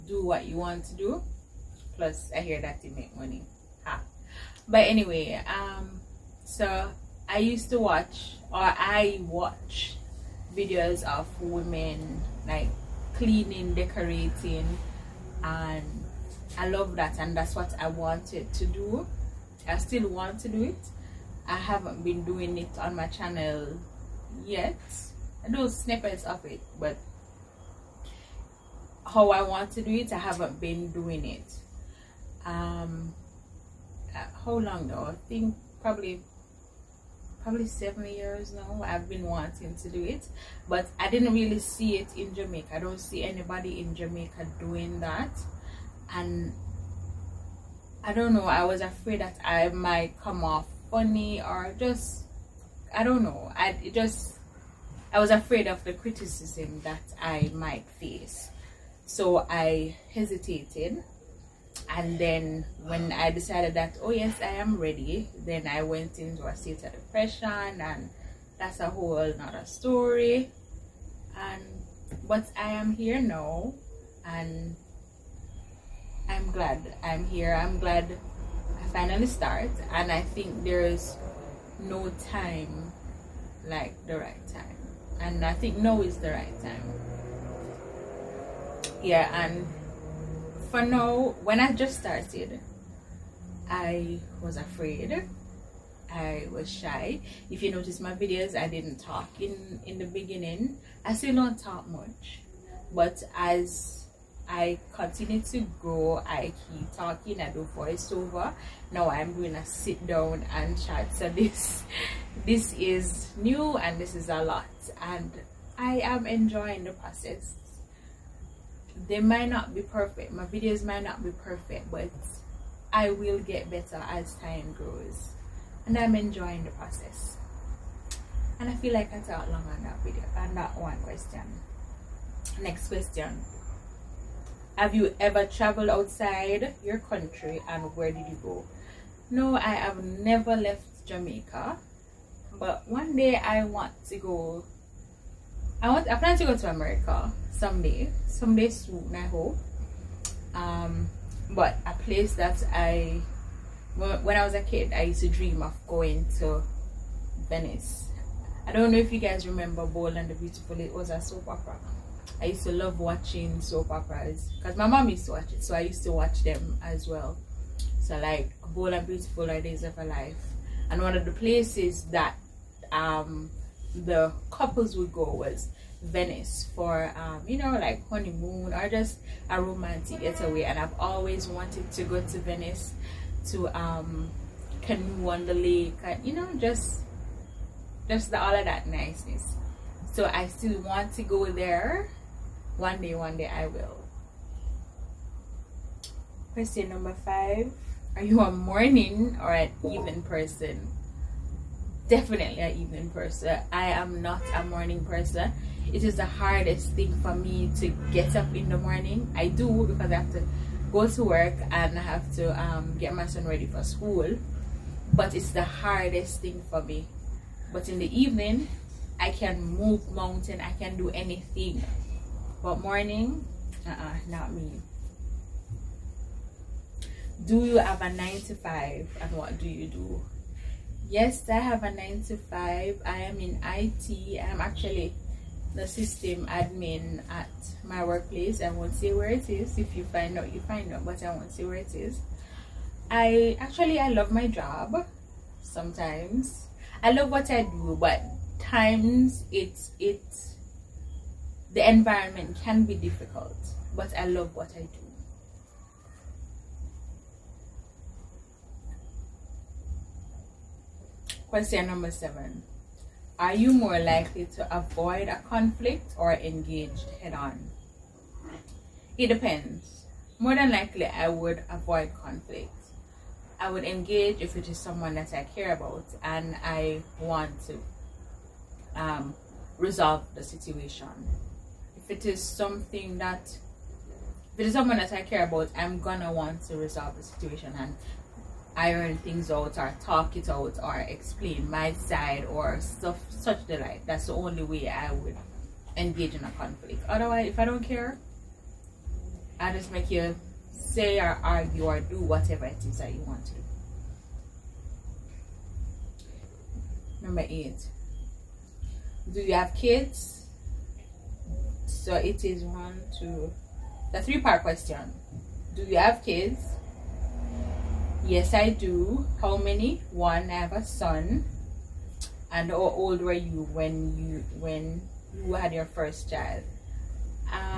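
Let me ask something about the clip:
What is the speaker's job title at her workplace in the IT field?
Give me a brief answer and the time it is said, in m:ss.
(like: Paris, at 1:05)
System admin, at 3:55.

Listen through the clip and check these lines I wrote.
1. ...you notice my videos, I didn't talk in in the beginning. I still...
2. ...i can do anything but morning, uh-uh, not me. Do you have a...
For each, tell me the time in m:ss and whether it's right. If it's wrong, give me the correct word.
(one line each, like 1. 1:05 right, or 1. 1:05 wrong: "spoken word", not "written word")
1. 1:37 right
2. 3:40 right.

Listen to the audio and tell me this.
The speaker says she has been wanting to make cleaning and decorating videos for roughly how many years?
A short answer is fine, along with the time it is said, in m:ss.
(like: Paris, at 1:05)
7, at 0:37.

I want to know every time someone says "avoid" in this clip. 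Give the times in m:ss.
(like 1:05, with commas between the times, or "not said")
4:24, 4:31.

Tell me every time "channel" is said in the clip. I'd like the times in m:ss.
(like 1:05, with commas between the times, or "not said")
0:23.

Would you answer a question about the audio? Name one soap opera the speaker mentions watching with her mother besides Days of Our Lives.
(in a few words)
Bold and the Beautiful.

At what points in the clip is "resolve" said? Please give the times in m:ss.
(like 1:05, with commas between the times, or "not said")
4:39, 4:46.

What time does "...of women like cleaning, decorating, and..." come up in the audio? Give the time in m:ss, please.
0:11.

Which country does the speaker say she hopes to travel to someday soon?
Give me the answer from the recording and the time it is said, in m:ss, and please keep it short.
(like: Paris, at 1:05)
America, at 2:26.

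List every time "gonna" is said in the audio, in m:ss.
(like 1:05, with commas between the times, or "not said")
1:49, 4:45.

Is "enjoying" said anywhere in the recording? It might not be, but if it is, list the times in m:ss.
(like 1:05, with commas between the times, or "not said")
1:56, 2:06.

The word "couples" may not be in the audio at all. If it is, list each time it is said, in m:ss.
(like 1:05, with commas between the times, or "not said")
2:54.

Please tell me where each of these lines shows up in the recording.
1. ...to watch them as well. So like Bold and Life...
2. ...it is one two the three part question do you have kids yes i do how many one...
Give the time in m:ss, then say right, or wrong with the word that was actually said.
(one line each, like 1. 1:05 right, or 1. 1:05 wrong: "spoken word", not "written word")
1. 2:46 wrong: "Beautiful", not "Life"
2. 5:12 right.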